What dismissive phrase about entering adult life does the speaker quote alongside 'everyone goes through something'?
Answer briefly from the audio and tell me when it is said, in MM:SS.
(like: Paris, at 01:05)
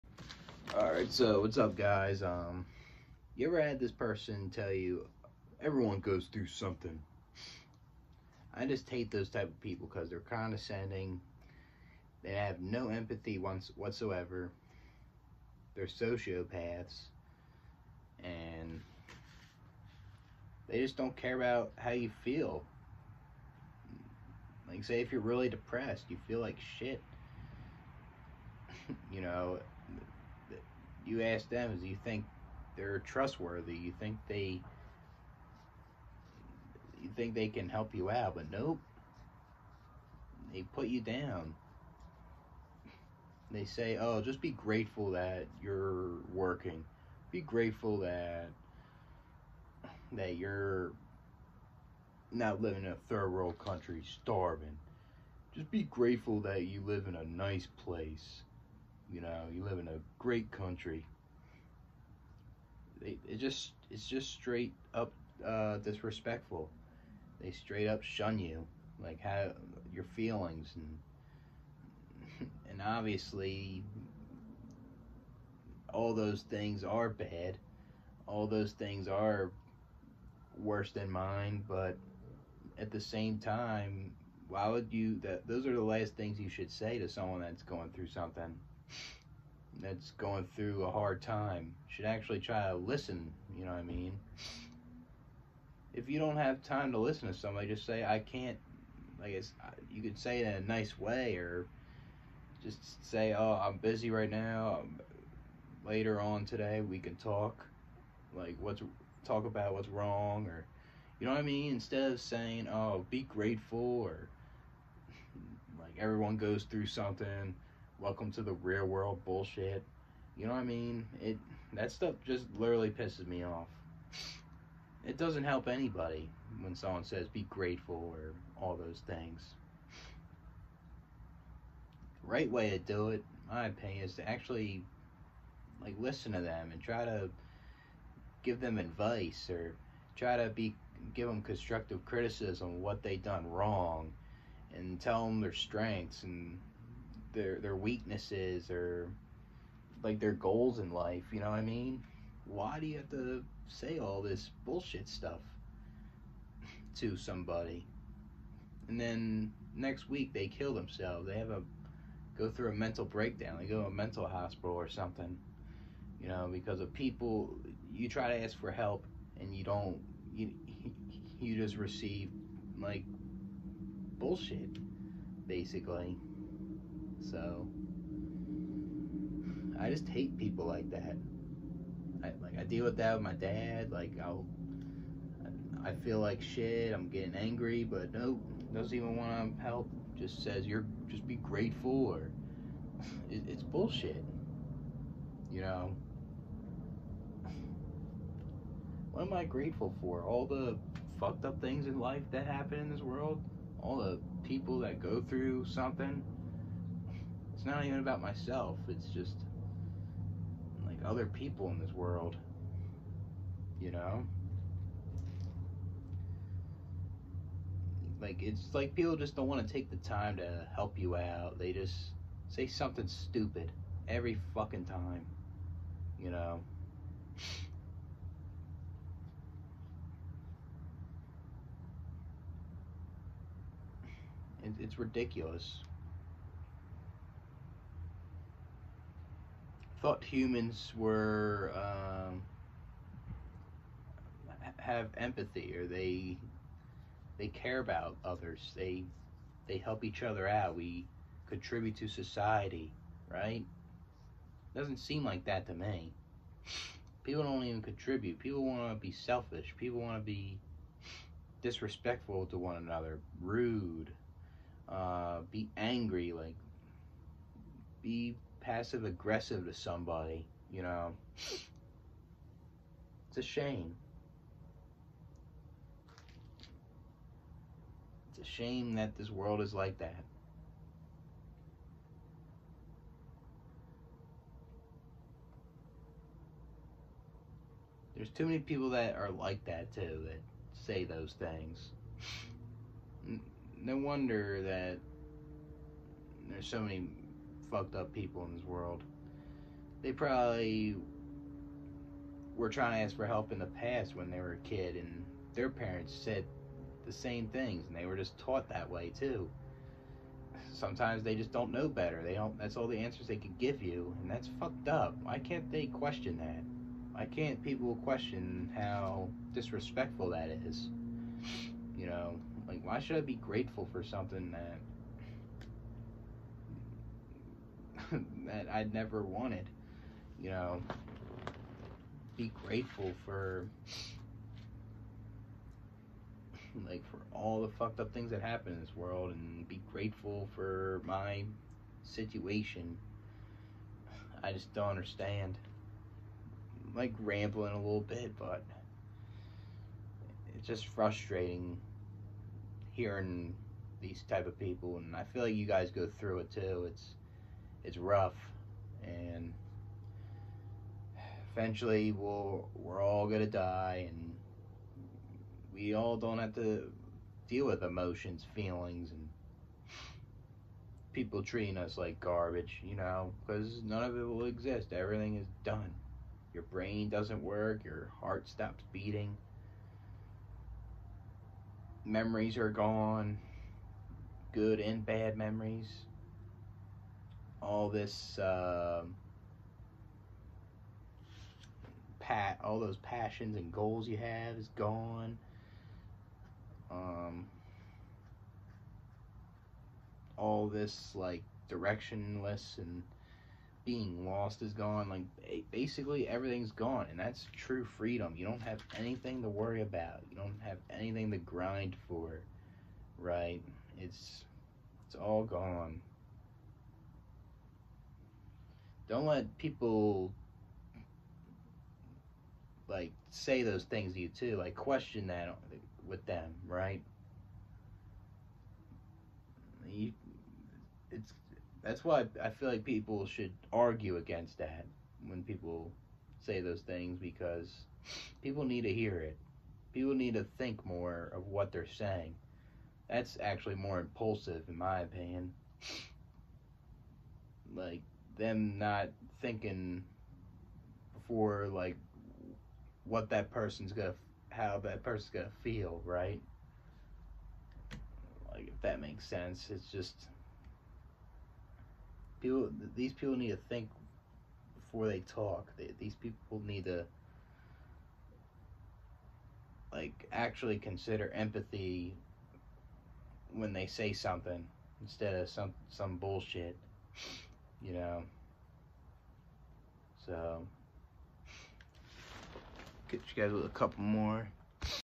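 welcome to the real world, at 01:58.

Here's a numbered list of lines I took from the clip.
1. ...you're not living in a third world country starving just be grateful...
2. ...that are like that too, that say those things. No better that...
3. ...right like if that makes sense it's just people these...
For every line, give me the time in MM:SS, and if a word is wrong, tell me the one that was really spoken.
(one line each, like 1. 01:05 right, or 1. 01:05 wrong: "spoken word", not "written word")
1. 00:50 right
2. 04:48 wrong: "wonder", not "better"
3. 07:36 right.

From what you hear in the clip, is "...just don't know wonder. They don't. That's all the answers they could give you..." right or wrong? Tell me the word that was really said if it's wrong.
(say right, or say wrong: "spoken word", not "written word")
wrong: "better", not "wonder".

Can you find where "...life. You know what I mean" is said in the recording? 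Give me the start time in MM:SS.
02:30.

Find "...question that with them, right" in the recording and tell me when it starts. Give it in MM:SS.
07:04.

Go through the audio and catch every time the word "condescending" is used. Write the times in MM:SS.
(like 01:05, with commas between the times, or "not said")
00:10.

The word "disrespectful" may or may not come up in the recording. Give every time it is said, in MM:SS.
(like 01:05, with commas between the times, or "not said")
01:05, 04:21, 05:19.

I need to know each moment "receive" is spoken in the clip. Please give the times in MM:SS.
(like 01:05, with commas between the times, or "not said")
02:51.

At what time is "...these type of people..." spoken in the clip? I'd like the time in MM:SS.
05:54.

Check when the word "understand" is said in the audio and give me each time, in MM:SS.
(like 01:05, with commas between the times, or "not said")
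05:44.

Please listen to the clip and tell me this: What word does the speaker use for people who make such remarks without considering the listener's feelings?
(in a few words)
impulsive.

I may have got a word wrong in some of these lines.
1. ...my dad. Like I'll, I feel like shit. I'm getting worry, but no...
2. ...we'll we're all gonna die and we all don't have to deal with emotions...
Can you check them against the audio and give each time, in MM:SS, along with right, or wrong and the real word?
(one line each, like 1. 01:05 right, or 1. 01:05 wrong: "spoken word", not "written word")
1. 03:03 wrong: "angry", not "worry"
2. 06:02 right.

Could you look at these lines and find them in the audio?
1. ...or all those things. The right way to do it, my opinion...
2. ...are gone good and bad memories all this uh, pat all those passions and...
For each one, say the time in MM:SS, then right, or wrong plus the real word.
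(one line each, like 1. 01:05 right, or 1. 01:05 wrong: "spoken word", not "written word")
1. 02:08 right
2. 06:22 right.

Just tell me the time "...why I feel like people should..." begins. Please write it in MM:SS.
07:12.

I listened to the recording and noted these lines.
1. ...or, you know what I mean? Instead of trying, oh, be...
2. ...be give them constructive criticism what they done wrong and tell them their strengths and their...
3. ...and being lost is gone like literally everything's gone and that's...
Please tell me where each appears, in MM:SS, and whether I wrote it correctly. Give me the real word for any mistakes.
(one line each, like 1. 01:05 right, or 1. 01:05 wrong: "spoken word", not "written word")
1. 01:50 wrong: "saying", not "trying"
2. 02:20 right
3. 06:42 wrong: "basically", not "literally".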